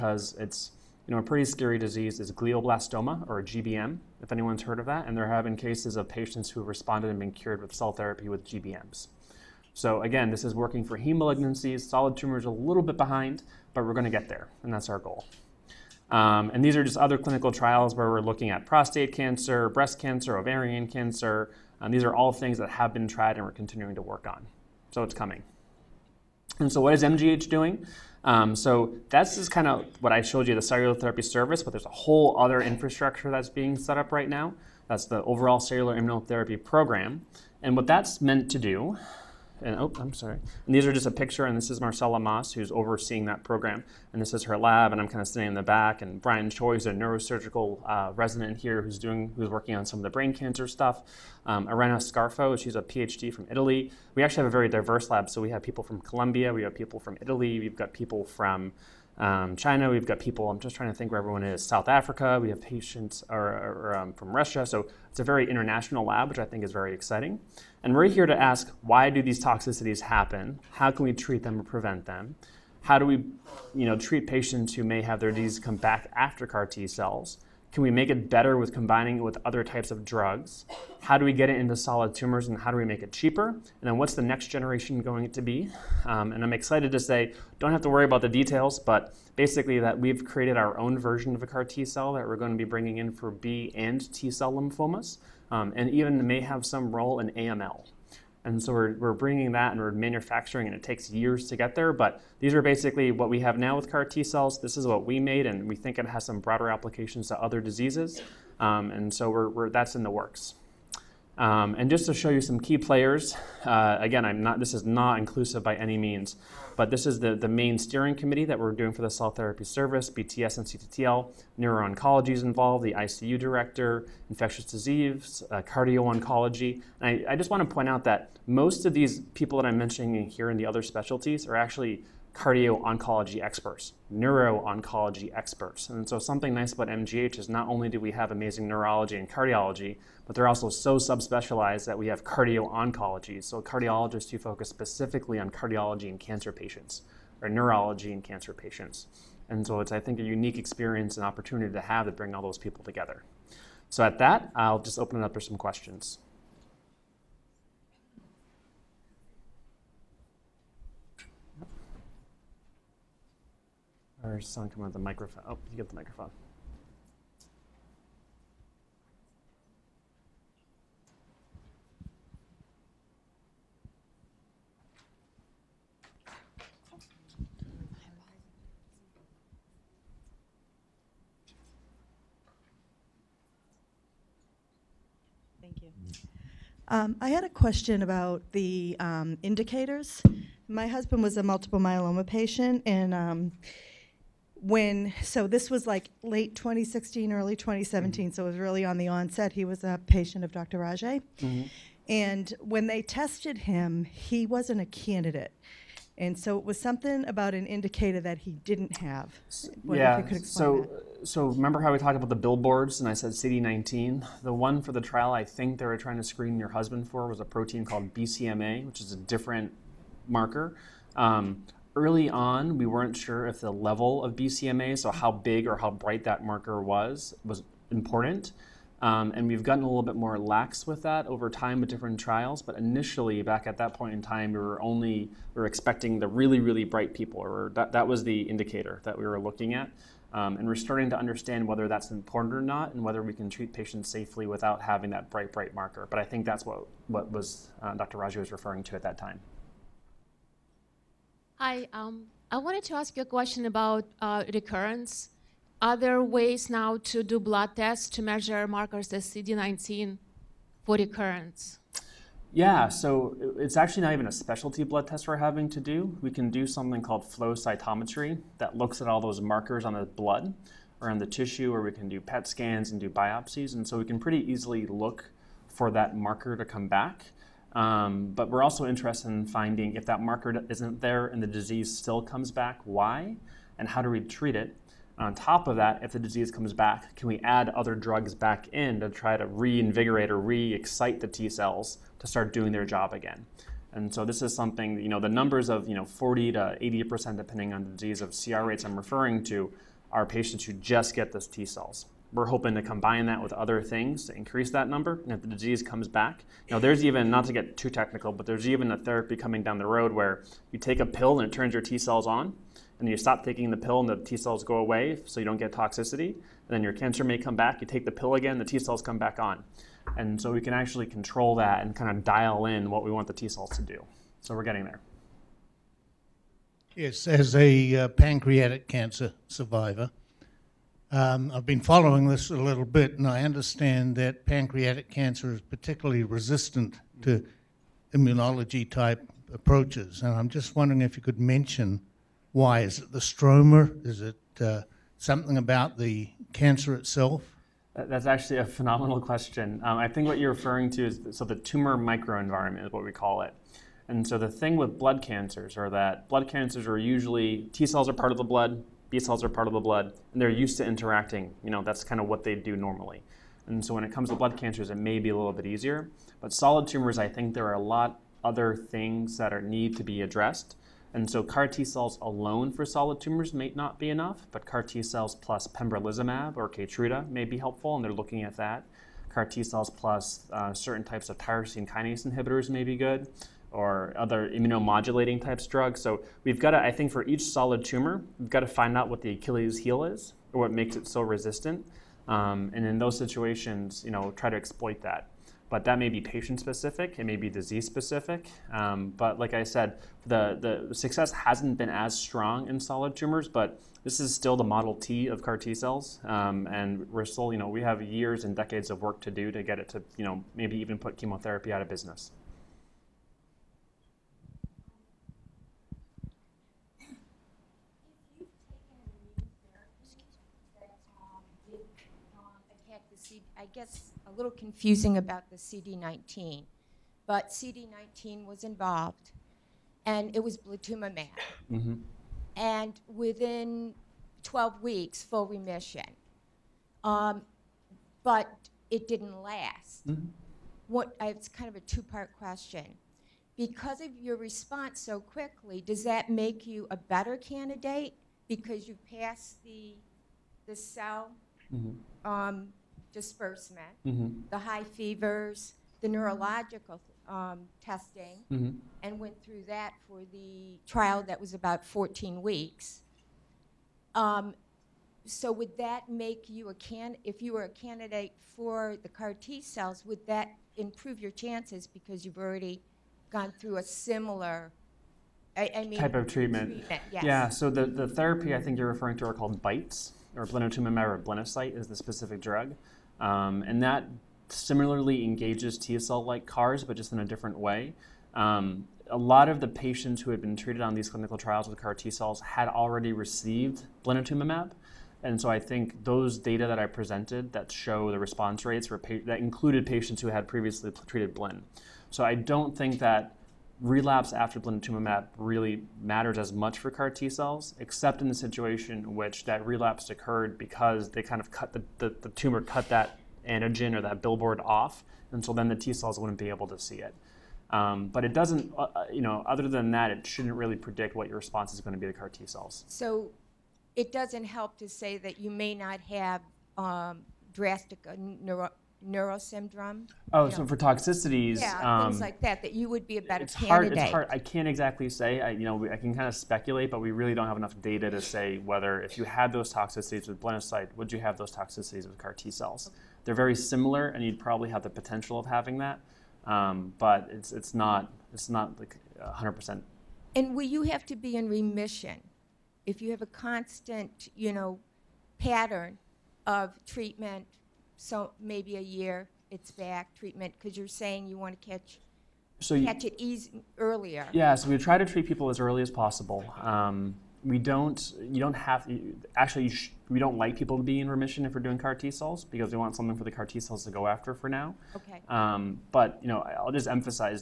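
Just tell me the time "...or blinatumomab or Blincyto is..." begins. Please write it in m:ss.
8:00.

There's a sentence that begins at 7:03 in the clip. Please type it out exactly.
I guess, a little confusing about the CD19, but CD19 was involved, and it was blinatumomab.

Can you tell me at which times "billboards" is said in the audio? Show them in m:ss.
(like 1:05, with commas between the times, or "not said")
3:32, 8:34.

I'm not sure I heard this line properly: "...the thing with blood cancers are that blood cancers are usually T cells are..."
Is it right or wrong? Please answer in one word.
right.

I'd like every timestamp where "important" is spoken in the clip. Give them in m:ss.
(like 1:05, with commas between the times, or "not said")
3:47, 4:02.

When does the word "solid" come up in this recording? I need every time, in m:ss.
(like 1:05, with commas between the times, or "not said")
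0:11, 1:21, 6:06, 6:12, 6:27, 6:42.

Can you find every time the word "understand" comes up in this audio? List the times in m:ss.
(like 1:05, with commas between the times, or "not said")
4:01, 5:33.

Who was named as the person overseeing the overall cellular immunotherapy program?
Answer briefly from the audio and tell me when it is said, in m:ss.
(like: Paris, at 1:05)
Marcela Maus, at 0:41.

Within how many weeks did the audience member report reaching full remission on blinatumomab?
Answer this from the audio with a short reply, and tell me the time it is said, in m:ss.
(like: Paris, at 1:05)
12, at 7:14.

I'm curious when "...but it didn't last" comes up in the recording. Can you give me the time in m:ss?
7:18.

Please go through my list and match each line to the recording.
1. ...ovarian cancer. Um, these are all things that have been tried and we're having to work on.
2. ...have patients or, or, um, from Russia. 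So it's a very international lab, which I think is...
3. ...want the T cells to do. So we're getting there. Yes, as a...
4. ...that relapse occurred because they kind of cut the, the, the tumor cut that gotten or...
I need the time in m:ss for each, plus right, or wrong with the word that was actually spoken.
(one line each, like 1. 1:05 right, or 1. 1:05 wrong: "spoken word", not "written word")
1. 0:20 wrong: "continuing", not "having"
2. 1:02 right
3. 5:23 right
4. 8:29 wrong: "antigen", not "gotten".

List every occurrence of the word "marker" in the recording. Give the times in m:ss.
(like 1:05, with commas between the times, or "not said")
3:40, 3:46, 4:05, 4:18, 4:29, 4:36, 4:40.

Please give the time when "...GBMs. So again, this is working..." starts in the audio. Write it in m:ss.
0:08.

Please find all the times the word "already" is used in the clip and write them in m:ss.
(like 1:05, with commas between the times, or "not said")
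7:52, 8:12.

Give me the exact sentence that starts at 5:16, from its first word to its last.
And then your cancer may come back, you take the pill again, the T cells come back on.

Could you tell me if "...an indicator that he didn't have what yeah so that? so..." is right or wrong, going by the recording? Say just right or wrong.
right.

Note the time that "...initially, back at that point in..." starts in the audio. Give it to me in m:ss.
3:52.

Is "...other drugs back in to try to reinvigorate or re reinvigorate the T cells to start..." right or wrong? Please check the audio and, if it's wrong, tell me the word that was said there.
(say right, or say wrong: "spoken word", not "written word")
wrong: "excite", not "reinvigorate".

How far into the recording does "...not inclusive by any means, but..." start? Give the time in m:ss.
1:54.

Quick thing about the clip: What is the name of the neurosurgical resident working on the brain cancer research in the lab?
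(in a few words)
Bryan Choi.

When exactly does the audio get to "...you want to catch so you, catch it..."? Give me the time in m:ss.
9:21.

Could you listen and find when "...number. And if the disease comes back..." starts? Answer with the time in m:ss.
5:04.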